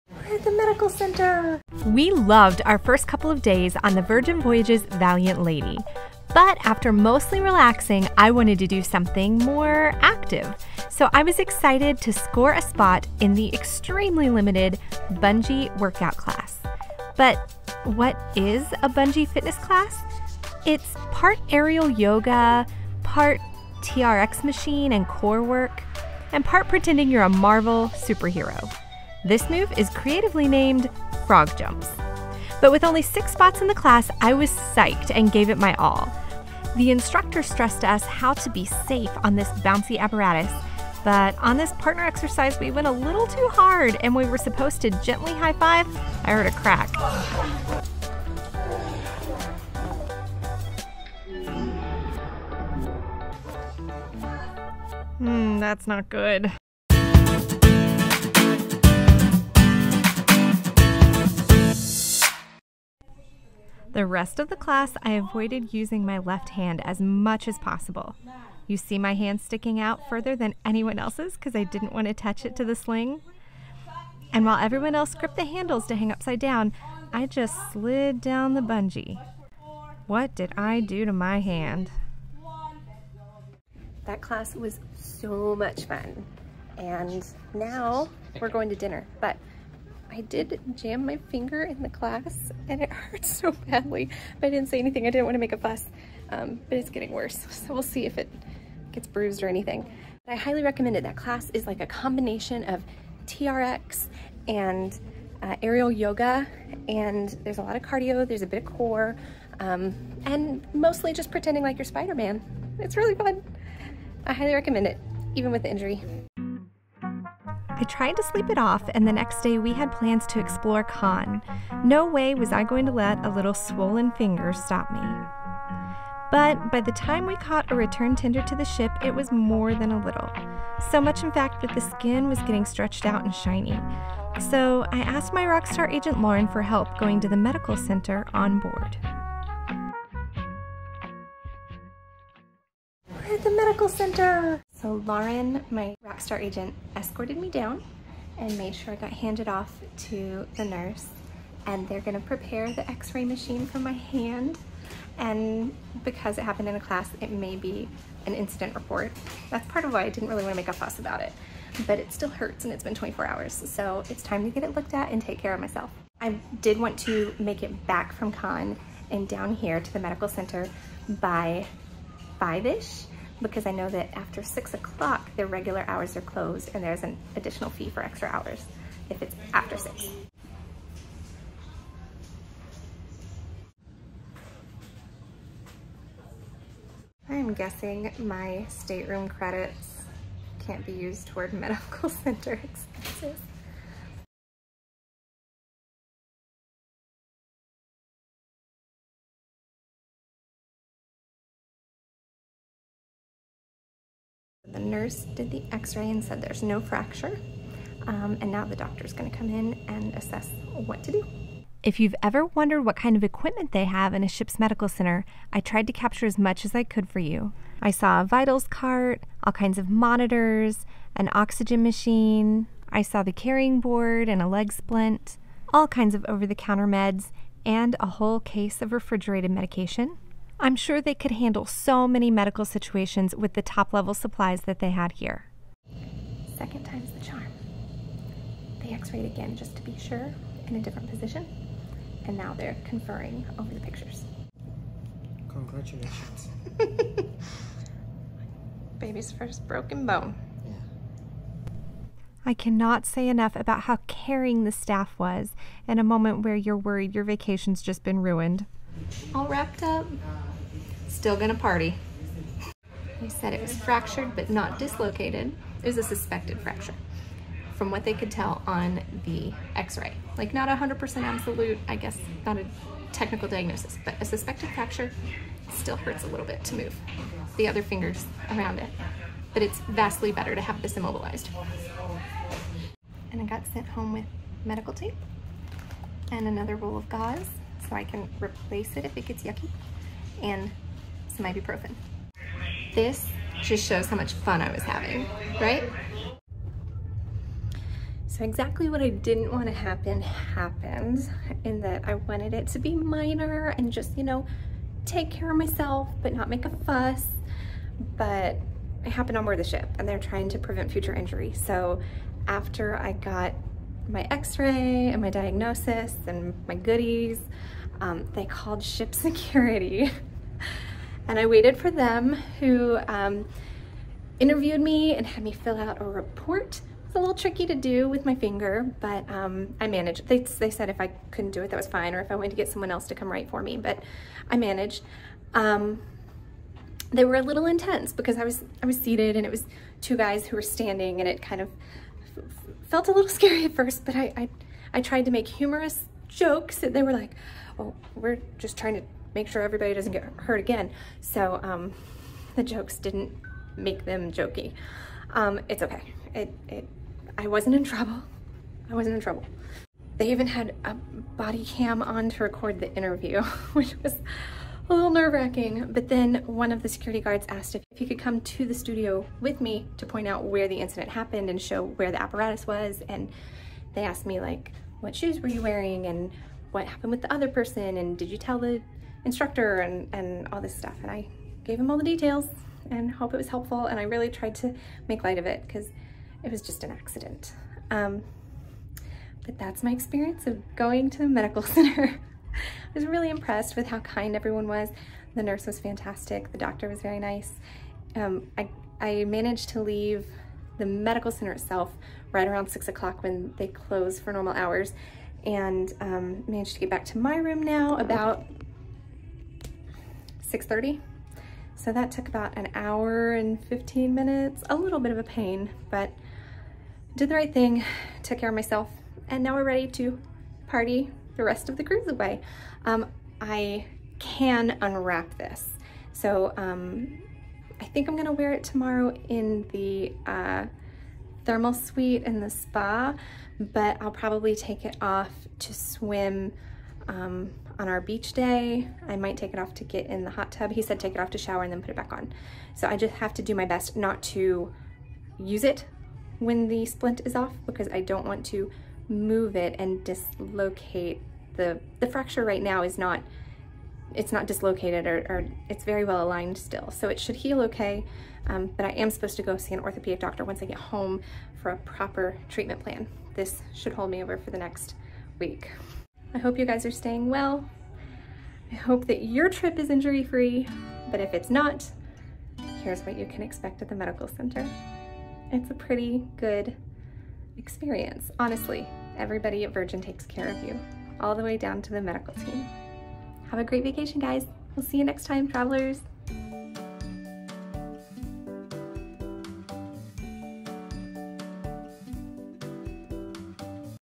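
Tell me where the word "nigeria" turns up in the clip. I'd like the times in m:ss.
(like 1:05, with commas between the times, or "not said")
not said.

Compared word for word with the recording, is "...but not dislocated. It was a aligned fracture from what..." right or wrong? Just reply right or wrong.
wrong.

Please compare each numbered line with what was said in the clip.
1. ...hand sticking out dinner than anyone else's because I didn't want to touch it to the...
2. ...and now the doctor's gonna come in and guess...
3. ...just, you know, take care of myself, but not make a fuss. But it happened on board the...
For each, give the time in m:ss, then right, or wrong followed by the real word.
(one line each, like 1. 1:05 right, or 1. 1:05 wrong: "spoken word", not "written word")
1. 1:09 wrong: "further", not "dinner"
2. 3:28 wrong: "assess", not "guess"
3. 5:03 right.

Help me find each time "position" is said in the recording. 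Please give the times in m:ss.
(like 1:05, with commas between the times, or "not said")
4:01.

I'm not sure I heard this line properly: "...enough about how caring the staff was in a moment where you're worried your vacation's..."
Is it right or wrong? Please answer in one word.
right.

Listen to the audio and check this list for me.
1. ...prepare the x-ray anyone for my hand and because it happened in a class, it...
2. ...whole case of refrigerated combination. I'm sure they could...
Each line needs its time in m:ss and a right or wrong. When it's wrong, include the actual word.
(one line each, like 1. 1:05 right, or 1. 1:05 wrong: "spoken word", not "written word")
1. 2:32 wrong: "machine", not "anyone"
2. 3:48 wrong: "medication", not "combination".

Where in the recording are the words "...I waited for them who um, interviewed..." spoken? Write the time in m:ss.
5:21.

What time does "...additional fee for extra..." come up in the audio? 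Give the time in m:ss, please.
2:57.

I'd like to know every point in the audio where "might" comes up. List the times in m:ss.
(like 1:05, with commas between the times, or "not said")
7:19.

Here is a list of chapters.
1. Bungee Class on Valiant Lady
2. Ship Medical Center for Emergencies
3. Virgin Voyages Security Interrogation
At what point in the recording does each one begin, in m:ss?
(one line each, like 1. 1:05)
1. 0:18
2. 2:20
3. 4:57.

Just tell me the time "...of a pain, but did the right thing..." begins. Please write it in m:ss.
6:55.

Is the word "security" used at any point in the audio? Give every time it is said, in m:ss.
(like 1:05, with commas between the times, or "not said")
5:19, 6:06.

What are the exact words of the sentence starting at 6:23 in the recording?
And I really tried to make light of it because it was just an accident.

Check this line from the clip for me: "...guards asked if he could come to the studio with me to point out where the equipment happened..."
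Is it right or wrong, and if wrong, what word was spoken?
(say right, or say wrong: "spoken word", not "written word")
wrong: "incident", not "equipment".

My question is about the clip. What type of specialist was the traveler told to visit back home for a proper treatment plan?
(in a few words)
Orthopedic doctor.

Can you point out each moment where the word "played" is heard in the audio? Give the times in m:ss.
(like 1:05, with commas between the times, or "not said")
not said.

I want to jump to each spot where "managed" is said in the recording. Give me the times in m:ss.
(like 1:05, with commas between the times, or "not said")
5:29, 5:34, 6:39, 6:46.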